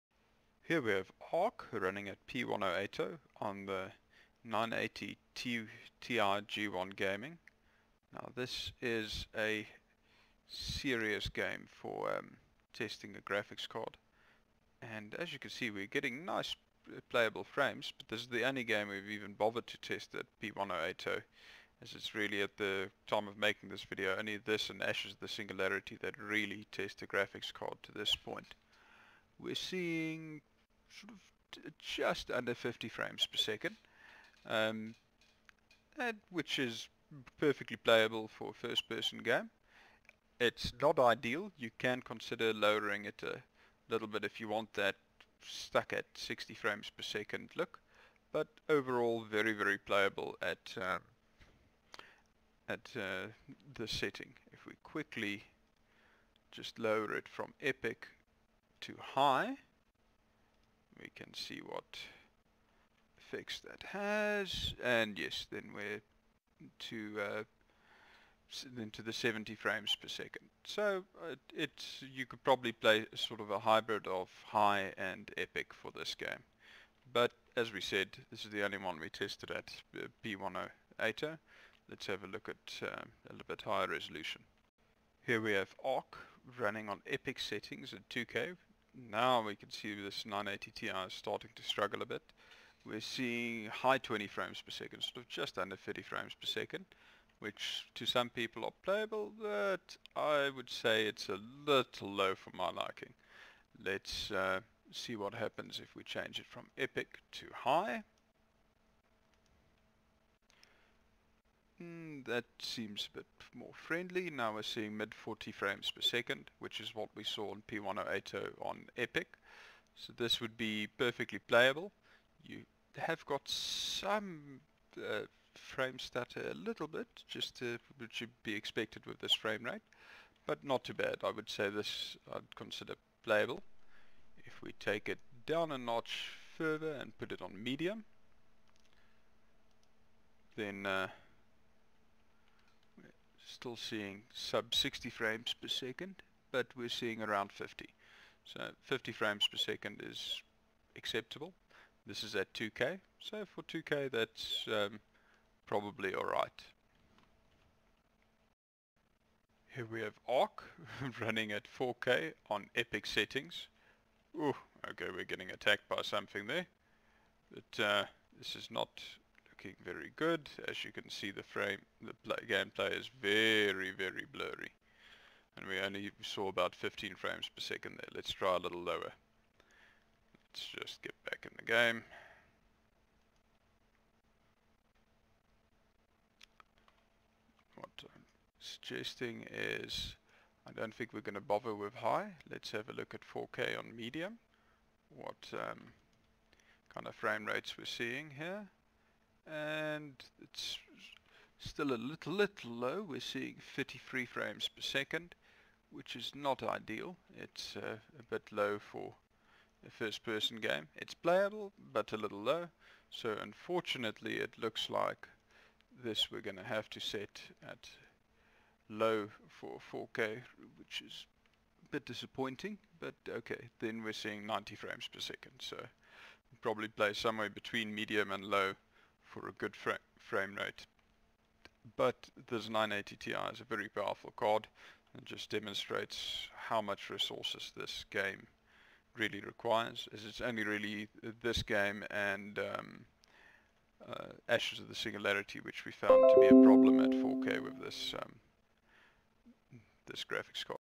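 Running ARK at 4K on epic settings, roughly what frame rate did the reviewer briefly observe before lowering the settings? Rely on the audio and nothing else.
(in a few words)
15 frames per second.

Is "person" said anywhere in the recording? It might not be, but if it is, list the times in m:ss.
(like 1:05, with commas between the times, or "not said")
0:38, 3:30.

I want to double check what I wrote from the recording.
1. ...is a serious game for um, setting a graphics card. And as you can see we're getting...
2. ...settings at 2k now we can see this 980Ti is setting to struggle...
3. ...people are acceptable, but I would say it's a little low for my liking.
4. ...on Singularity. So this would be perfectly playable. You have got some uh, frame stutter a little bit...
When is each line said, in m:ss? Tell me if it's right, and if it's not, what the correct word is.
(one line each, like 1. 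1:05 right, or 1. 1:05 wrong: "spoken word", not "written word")
1. 0:08 wrong: "testing", not "setting"
2. 1:27 wrong: "starting", not "setting"
3. 1:38 wrong: "playable", not "acceptable"
4. 1:58 wrong: "Epic", not "Singularity".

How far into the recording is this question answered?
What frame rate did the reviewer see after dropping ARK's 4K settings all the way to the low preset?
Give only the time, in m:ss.
3:44.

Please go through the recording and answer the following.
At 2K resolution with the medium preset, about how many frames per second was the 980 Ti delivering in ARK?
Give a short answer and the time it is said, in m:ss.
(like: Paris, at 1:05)
around 50, at 2:27.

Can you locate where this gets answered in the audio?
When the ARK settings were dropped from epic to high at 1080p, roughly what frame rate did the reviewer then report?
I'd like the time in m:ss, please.
1:09.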